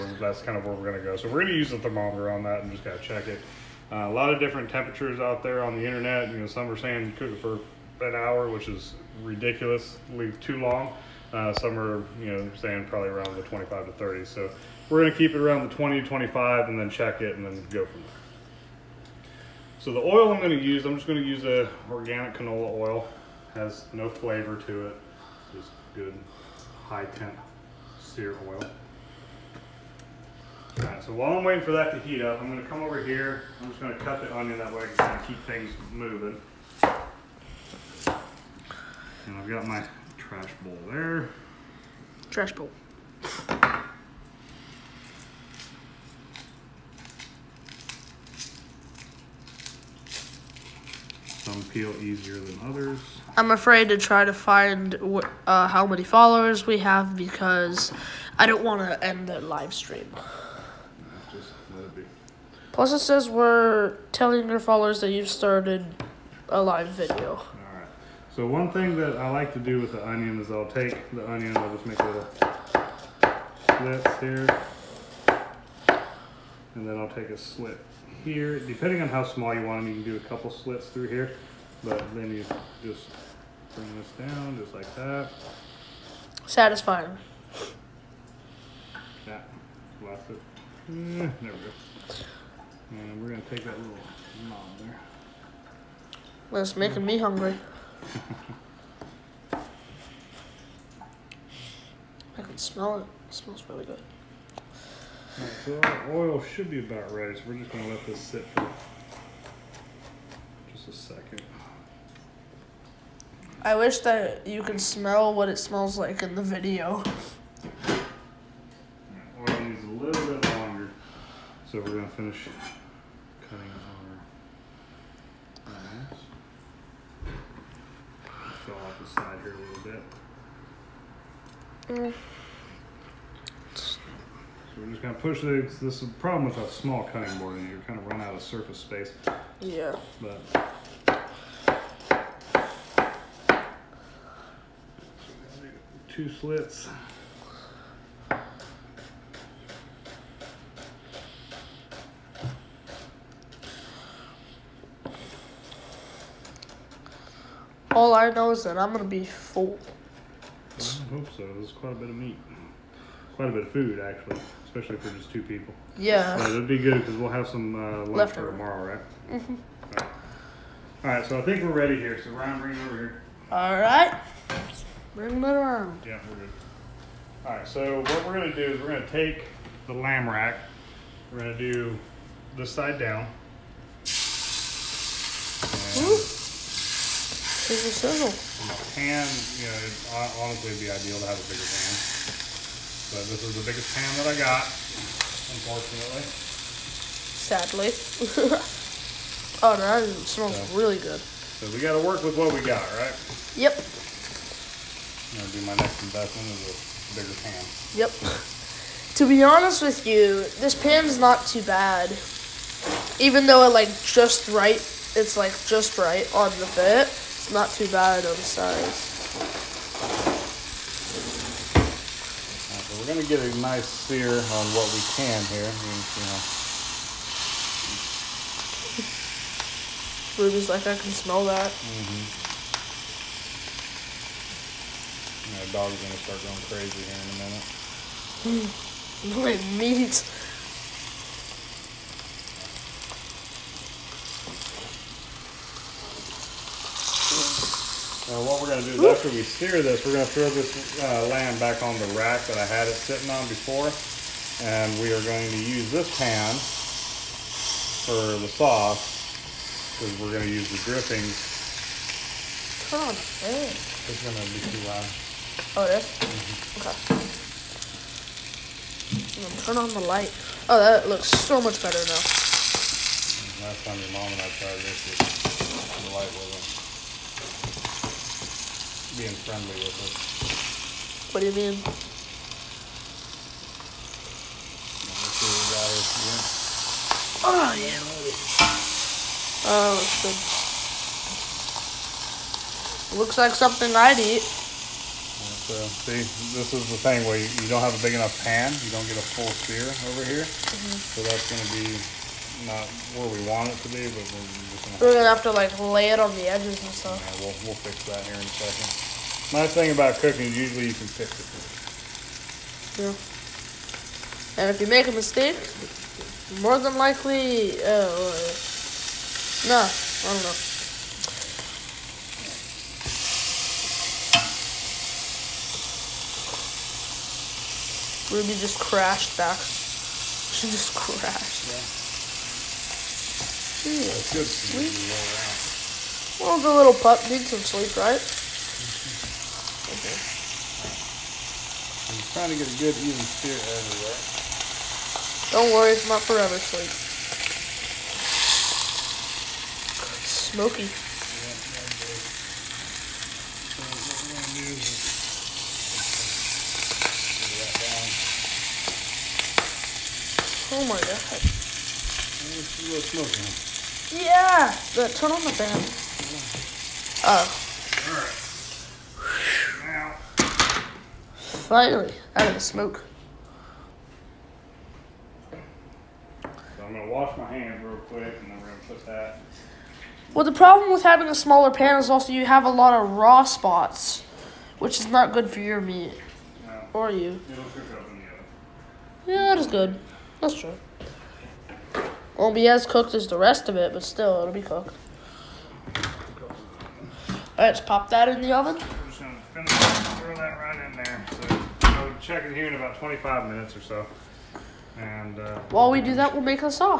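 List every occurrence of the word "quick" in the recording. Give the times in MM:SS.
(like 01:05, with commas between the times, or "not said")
06:17.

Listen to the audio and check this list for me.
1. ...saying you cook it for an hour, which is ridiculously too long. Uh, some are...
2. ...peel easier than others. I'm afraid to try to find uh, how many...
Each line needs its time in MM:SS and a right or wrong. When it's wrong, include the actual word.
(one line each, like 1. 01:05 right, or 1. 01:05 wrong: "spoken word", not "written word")
1. 00:06 right
2. 00:51 right.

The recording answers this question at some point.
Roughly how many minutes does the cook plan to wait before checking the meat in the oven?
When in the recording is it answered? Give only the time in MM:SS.
06:42.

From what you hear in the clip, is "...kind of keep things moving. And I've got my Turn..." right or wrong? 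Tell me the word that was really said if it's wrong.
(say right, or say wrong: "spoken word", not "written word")
wrong: "Trash", not "Turn".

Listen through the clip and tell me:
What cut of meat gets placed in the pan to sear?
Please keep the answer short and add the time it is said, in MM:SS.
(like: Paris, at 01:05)
lamb rack, at 02:59.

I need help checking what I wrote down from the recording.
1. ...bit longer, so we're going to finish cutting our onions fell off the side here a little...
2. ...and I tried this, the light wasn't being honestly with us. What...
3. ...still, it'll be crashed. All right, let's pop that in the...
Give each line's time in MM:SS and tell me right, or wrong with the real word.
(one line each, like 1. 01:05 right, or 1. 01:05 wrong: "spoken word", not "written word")
1. 02:00 right
2. 04:34 wrong: "friendly", not "honestly"
3. 06:34 wrong: "cooked", not "crashed".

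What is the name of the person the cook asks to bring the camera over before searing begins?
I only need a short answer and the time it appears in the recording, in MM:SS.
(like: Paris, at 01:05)
Ryan, at 02:52.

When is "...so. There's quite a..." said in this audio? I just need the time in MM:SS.
02:41.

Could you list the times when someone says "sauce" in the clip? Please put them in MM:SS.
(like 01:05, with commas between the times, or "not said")
04:18.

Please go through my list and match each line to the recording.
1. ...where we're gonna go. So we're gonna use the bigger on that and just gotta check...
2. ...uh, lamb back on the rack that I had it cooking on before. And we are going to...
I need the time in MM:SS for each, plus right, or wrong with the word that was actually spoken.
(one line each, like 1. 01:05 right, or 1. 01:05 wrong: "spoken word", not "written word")
1. 00:00 wrong: "thermometer", not "bigger"
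2. 04:11 wrong: "sitting", not "cooking".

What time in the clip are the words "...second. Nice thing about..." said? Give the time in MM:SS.
05:08.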